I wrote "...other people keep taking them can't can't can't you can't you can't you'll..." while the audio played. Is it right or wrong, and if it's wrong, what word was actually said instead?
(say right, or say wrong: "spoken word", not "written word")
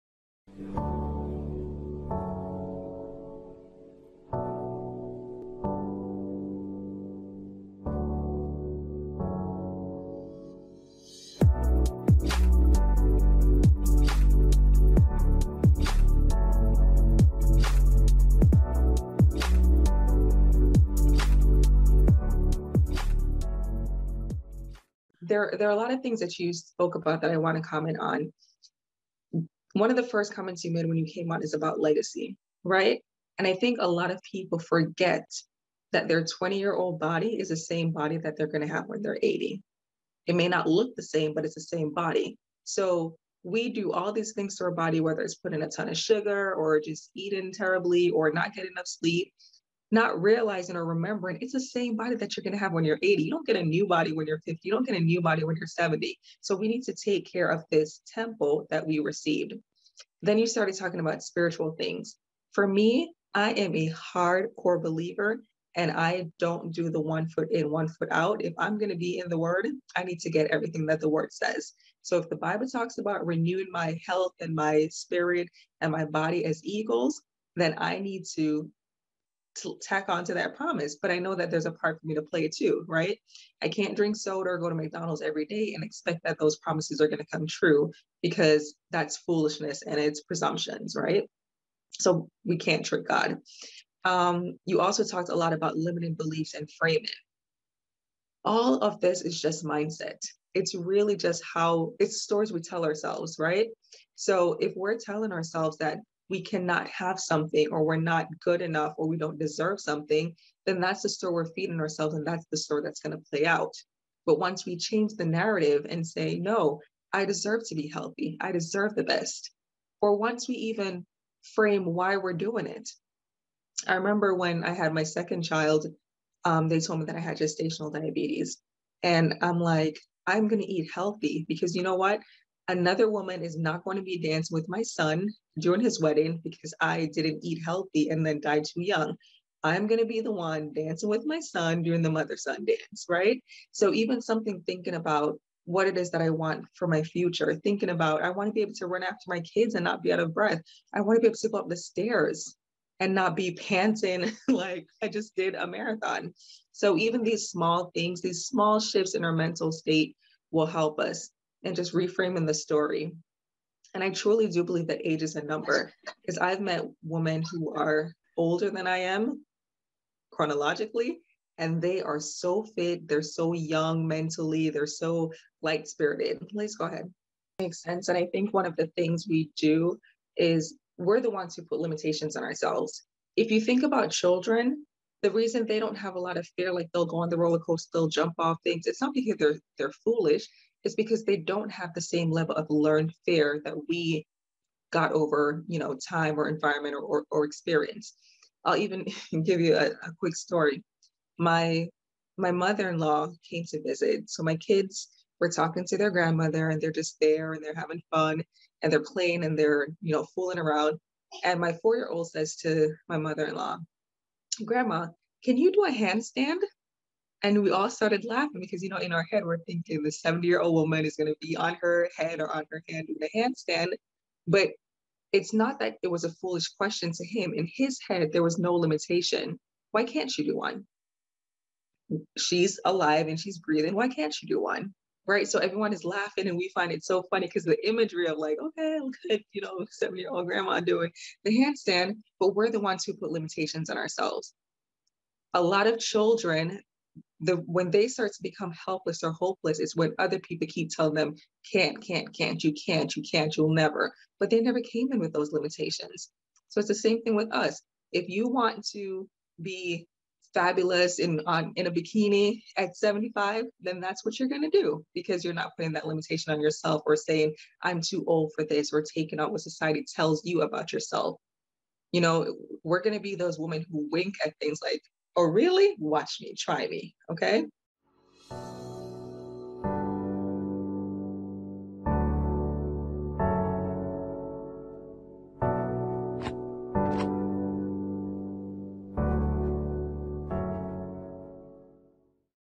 wrong: "telling", not "taking".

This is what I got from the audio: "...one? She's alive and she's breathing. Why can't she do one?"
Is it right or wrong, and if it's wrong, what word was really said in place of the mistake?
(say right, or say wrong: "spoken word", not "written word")
right.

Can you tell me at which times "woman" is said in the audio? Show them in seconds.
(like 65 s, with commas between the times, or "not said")
133 s, 220 s.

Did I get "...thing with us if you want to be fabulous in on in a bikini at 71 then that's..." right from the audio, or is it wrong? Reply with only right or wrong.
wrong.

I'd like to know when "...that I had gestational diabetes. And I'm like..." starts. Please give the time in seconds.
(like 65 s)
127 s.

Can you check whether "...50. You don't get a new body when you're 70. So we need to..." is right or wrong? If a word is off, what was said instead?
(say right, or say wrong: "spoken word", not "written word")
right.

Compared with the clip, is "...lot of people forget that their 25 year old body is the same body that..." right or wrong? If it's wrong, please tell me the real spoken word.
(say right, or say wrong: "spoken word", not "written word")
wrong: "20", not "25".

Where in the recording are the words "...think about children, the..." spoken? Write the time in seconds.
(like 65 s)
183 s.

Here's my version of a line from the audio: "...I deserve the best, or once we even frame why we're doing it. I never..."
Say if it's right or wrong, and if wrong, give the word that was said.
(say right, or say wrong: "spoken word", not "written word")
wrong: "remember", not "never".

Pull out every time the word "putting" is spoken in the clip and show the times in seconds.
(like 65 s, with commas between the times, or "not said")
45 s, 265 s.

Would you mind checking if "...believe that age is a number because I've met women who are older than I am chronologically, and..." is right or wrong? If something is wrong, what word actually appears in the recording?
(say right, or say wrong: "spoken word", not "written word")
right.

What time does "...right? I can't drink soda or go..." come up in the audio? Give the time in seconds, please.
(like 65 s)
82 s.